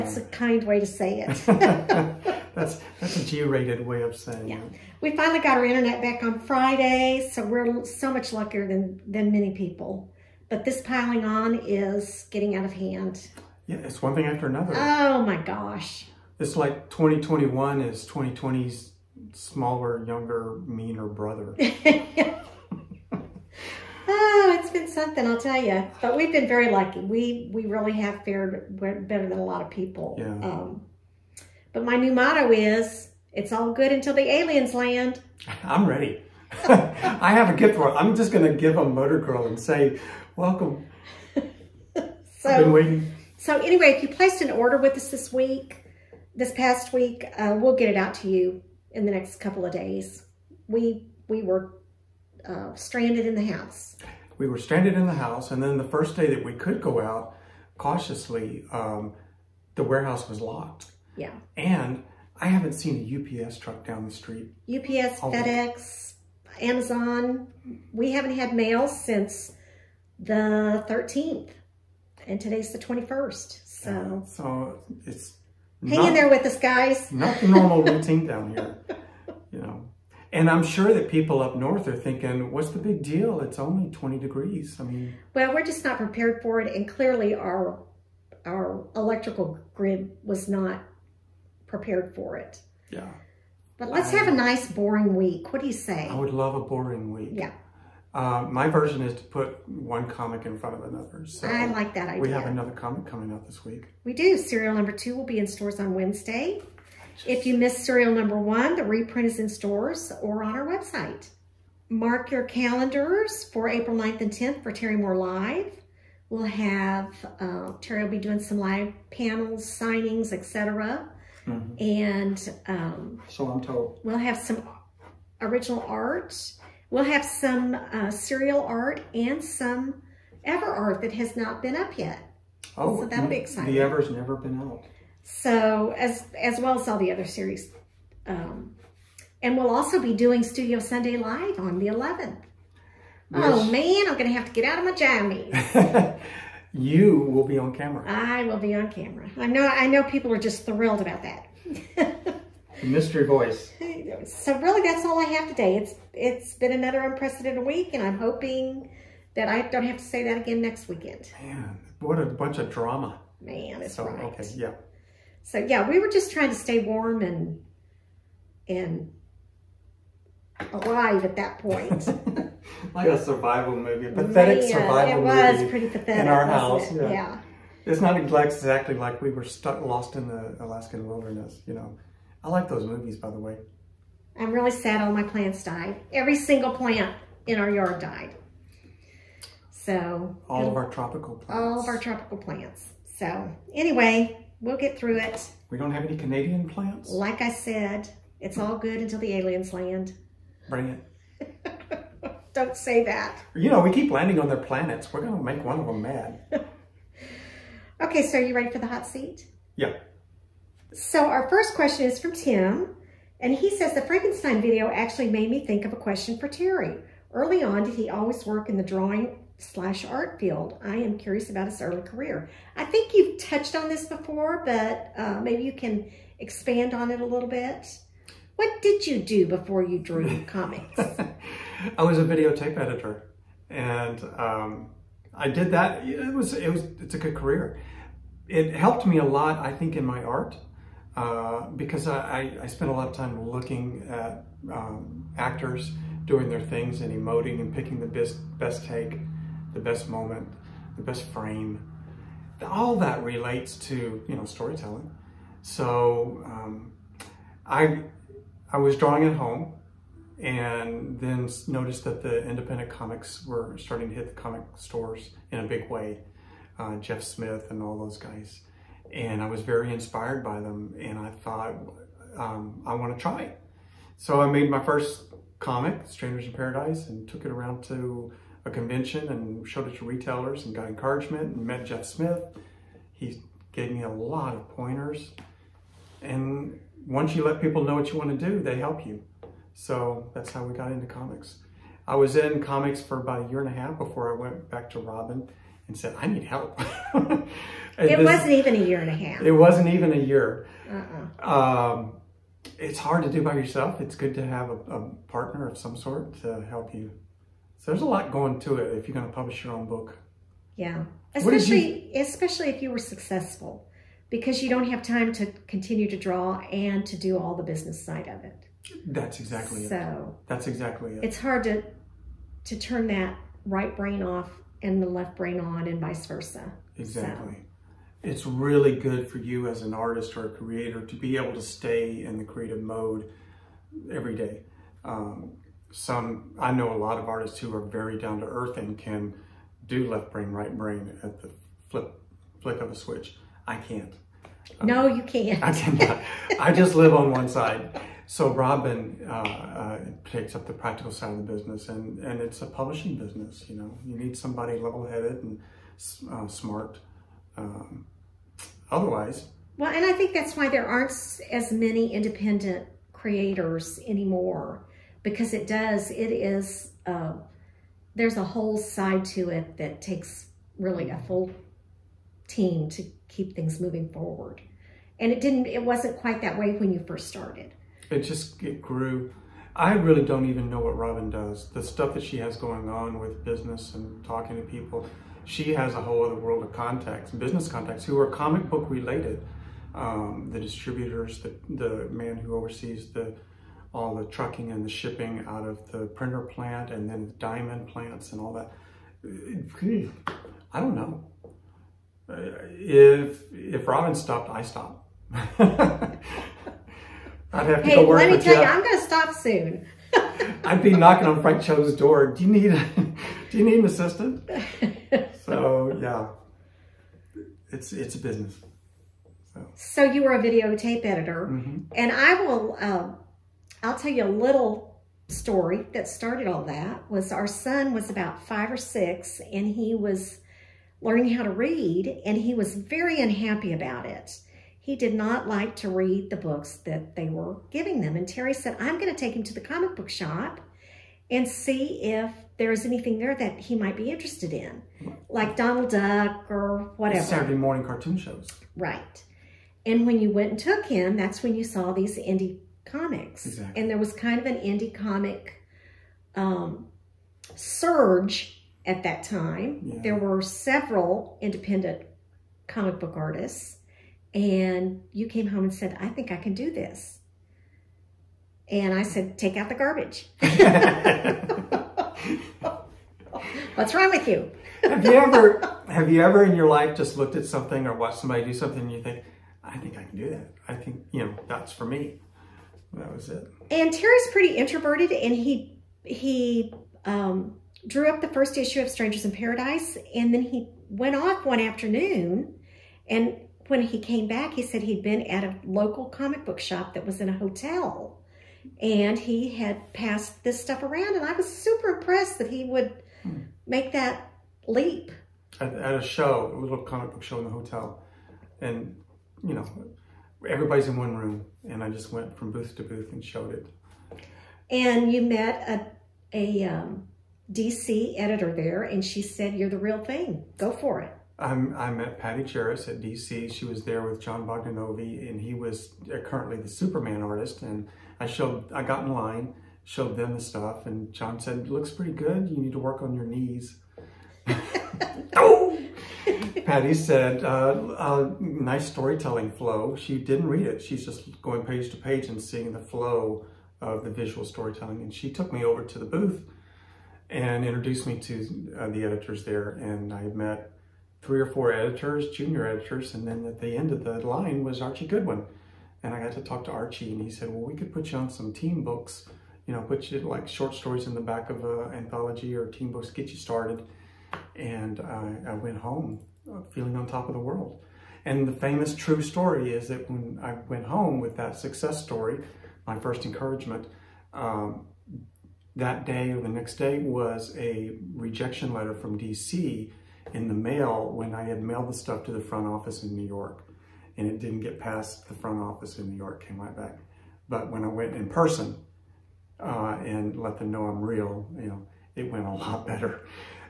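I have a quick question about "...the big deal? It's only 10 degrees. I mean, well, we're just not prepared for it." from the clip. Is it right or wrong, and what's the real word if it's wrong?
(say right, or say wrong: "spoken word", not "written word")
wrong: "20", not "10".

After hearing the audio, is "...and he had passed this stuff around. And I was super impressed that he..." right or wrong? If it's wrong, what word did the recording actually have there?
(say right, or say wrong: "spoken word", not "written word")
right.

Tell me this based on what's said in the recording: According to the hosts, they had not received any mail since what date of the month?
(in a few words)
13th.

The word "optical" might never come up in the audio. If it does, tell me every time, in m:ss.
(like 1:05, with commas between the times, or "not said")
not said.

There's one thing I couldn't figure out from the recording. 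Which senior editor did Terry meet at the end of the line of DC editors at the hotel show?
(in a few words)
Archie Goodwin.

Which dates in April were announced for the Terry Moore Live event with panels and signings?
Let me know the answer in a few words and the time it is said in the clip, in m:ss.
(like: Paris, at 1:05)
April 9th and 10th, at 1:53.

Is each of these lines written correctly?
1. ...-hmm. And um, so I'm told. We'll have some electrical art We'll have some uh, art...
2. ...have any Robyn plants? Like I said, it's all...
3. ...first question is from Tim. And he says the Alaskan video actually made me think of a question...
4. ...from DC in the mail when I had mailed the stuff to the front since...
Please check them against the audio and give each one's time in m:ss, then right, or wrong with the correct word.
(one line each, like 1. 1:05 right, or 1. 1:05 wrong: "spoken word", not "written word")
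1. 2:01 wrong: "original", not "electrical"
2. 3:15 wrong: "Canadian", not "Robyn"
3. 3:31 wrong: "Frankenstein", not "Alaskan"
4. 9:38 wrong: "office", not "since".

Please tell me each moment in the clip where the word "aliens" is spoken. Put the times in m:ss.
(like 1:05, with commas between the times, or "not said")
0:34, 3:19.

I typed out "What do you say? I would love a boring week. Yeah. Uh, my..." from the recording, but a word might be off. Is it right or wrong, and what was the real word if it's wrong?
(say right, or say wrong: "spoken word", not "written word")
right.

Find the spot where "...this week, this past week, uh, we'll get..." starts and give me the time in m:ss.
0:45.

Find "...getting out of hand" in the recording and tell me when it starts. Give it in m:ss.
0:12.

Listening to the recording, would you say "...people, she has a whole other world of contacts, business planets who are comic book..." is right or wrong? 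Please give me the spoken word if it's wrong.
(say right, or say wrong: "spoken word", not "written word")
wrong: "contacts", not "planets".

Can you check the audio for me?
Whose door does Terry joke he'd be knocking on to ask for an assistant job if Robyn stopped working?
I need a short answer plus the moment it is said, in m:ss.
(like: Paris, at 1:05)
Frank Cho, at 6:51.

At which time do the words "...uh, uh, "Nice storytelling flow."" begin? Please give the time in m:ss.
8:57.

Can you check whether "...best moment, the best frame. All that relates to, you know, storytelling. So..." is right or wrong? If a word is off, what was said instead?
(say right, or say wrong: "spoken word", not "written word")
right.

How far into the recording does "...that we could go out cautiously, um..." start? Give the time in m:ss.
0:56.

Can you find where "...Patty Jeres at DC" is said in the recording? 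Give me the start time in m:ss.
8:42.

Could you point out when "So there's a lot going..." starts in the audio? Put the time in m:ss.
5:07.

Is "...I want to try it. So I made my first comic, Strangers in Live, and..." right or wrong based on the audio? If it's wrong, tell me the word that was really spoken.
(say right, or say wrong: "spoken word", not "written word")
wrong: "Paradise", not "Live".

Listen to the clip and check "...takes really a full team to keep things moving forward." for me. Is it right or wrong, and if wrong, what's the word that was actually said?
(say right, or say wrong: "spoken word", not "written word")
right.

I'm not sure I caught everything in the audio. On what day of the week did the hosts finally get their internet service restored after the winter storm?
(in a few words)
Friday.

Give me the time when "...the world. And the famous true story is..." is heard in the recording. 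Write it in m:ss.
9:27.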